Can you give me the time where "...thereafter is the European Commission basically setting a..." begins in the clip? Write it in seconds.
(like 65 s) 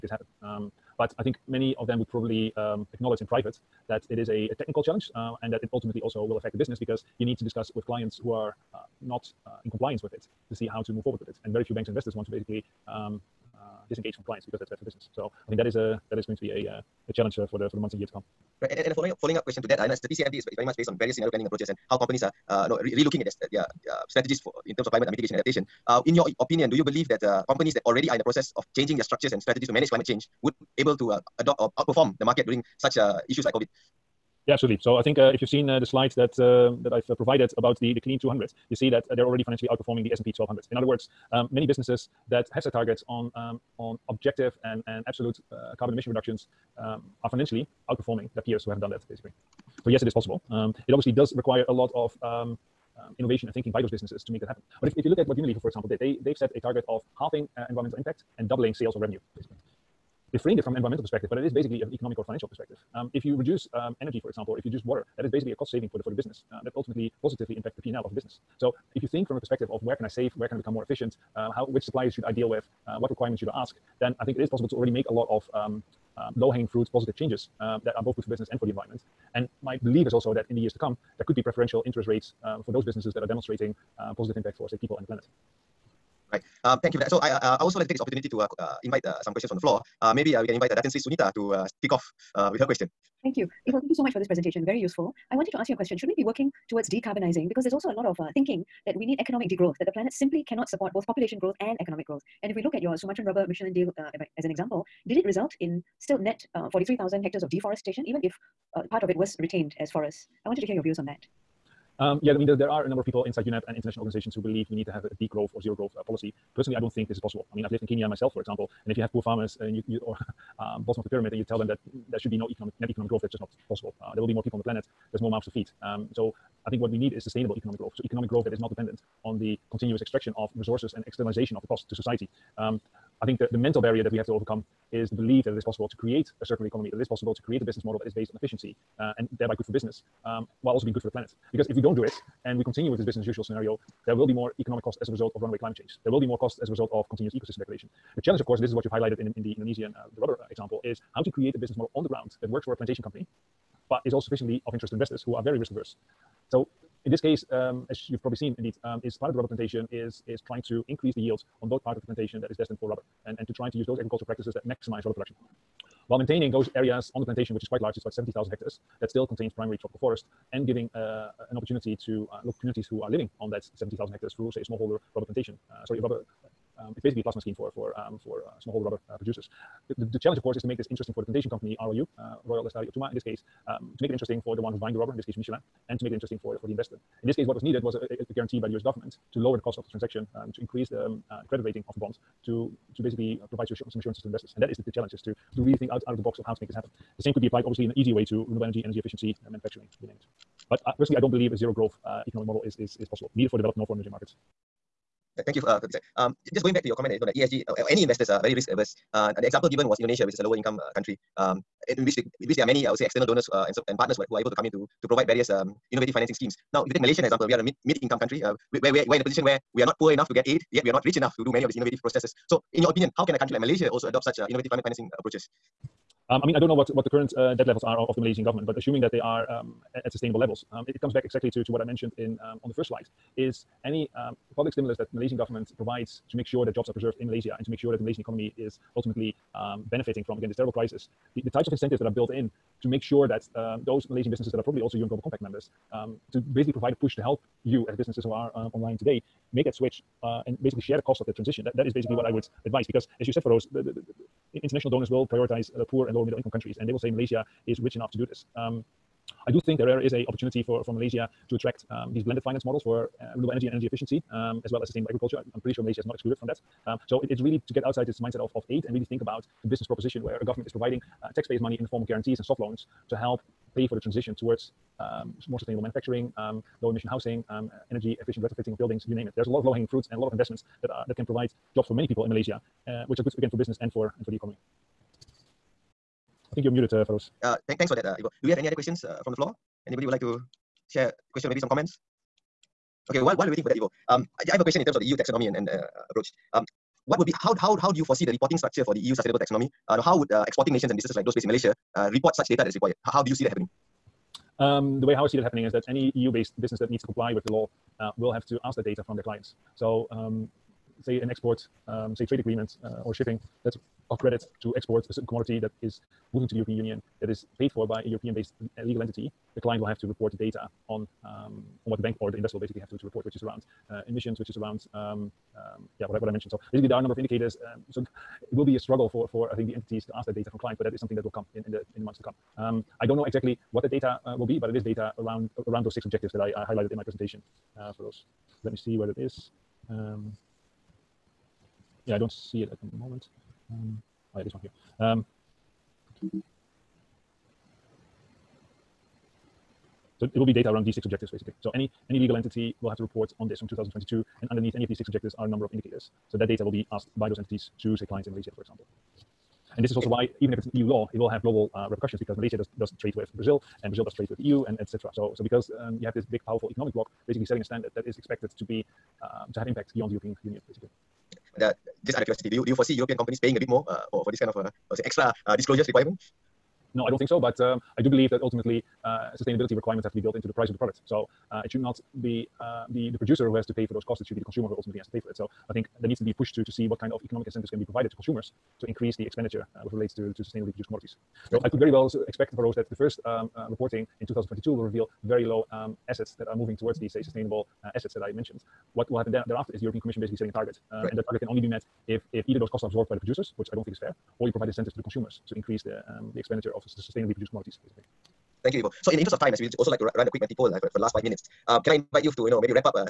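399 s.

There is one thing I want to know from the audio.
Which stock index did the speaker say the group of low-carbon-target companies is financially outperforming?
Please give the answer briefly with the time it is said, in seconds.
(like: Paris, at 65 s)
S&P 1200, at 40 s.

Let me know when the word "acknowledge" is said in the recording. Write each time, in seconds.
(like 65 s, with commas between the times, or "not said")
2 s.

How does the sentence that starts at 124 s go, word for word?
Uh, there will be more people on the planet.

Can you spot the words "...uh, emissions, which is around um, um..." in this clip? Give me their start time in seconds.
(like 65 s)
323 s.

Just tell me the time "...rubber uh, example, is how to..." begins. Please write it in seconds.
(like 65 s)
150 s.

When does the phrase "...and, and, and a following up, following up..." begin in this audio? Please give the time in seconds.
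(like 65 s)
18 s.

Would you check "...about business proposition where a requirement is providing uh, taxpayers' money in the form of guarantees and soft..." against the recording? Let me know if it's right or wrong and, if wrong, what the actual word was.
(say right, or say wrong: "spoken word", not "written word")
wrong: "government", not "requirement".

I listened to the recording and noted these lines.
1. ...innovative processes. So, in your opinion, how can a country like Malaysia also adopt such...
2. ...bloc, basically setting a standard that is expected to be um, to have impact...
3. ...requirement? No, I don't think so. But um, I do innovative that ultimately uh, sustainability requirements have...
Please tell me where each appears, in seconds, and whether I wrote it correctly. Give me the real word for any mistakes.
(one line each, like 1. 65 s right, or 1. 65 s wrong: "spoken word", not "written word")
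1. 221 s right
2. 366 s right
3. 375 s wrong: "believe", not "innovative".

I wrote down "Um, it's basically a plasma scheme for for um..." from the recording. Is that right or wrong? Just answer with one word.
right.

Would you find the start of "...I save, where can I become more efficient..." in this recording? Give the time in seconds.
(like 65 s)
70 s.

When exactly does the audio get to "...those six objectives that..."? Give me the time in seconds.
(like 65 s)
335 s.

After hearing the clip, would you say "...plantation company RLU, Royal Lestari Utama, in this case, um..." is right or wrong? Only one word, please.
right.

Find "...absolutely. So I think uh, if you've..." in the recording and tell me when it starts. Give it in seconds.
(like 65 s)
34 s.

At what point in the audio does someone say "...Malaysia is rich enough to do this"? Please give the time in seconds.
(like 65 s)
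257 s.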